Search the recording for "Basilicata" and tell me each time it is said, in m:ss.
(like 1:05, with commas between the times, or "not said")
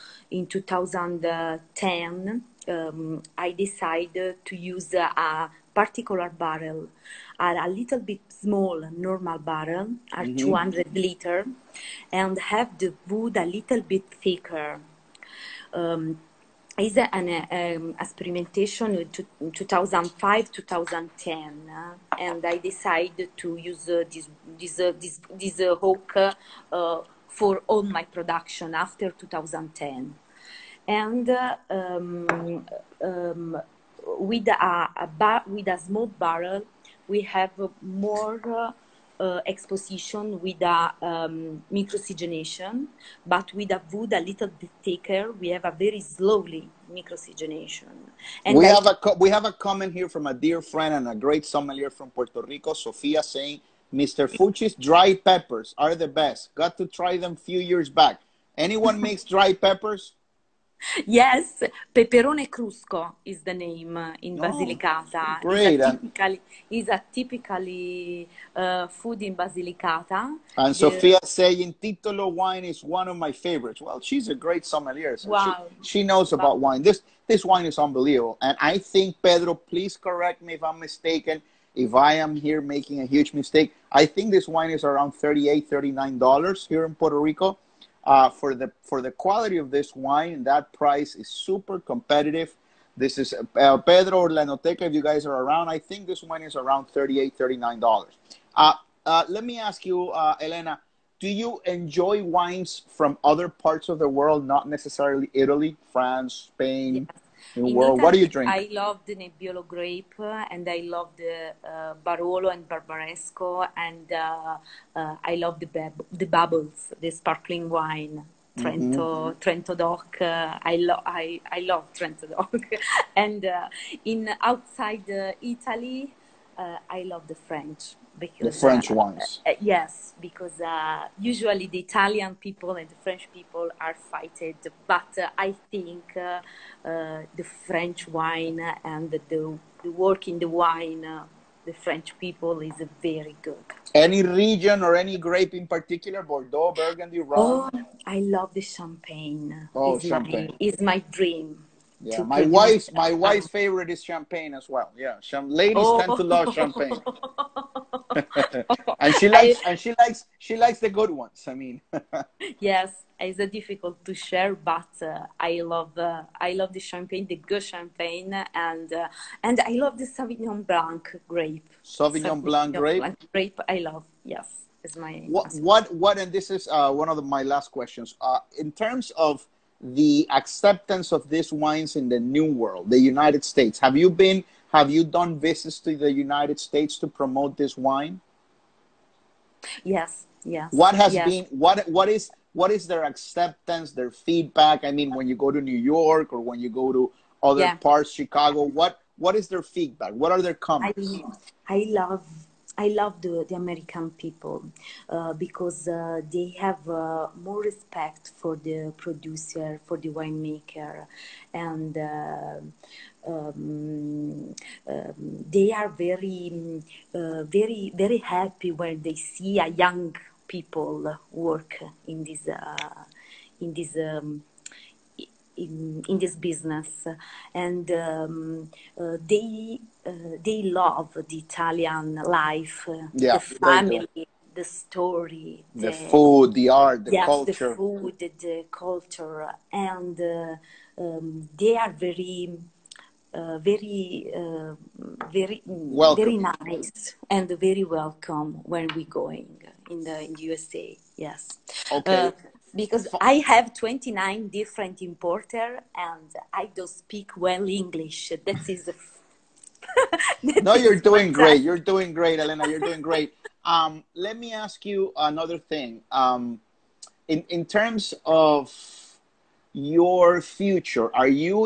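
1:04, 1:09.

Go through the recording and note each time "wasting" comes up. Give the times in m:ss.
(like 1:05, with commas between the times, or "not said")
not said.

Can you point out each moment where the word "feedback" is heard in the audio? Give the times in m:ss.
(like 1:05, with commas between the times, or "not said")
3:14, 3:19.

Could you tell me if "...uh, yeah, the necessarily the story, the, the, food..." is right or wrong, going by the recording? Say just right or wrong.
wrong.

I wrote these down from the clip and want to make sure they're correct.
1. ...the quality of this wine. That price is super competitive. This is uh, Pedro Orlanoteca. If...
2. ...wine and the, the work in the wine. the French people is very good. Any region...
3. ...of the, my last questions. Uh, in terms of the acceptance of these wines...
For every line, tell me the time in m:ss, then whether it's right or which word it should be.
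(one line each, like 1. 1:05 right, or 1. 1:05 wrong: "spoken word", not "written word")
1. 1:29 right
2. 2:18 right
3. 2:57 right.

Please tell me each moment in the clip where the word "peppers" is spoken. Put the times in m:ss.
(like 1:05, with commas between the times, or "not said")
0:55, 0:59.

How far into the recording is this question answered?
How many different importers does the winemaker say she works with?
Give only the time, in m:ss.
4:13.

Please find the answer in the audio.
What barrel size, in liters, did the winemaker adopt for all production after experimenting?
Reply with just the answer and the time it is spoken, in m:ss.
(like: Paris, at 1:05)
200 liters, at 0:10.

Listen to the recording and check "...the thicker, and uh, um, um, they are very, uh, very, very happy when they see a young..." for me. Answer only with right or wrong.
wrong.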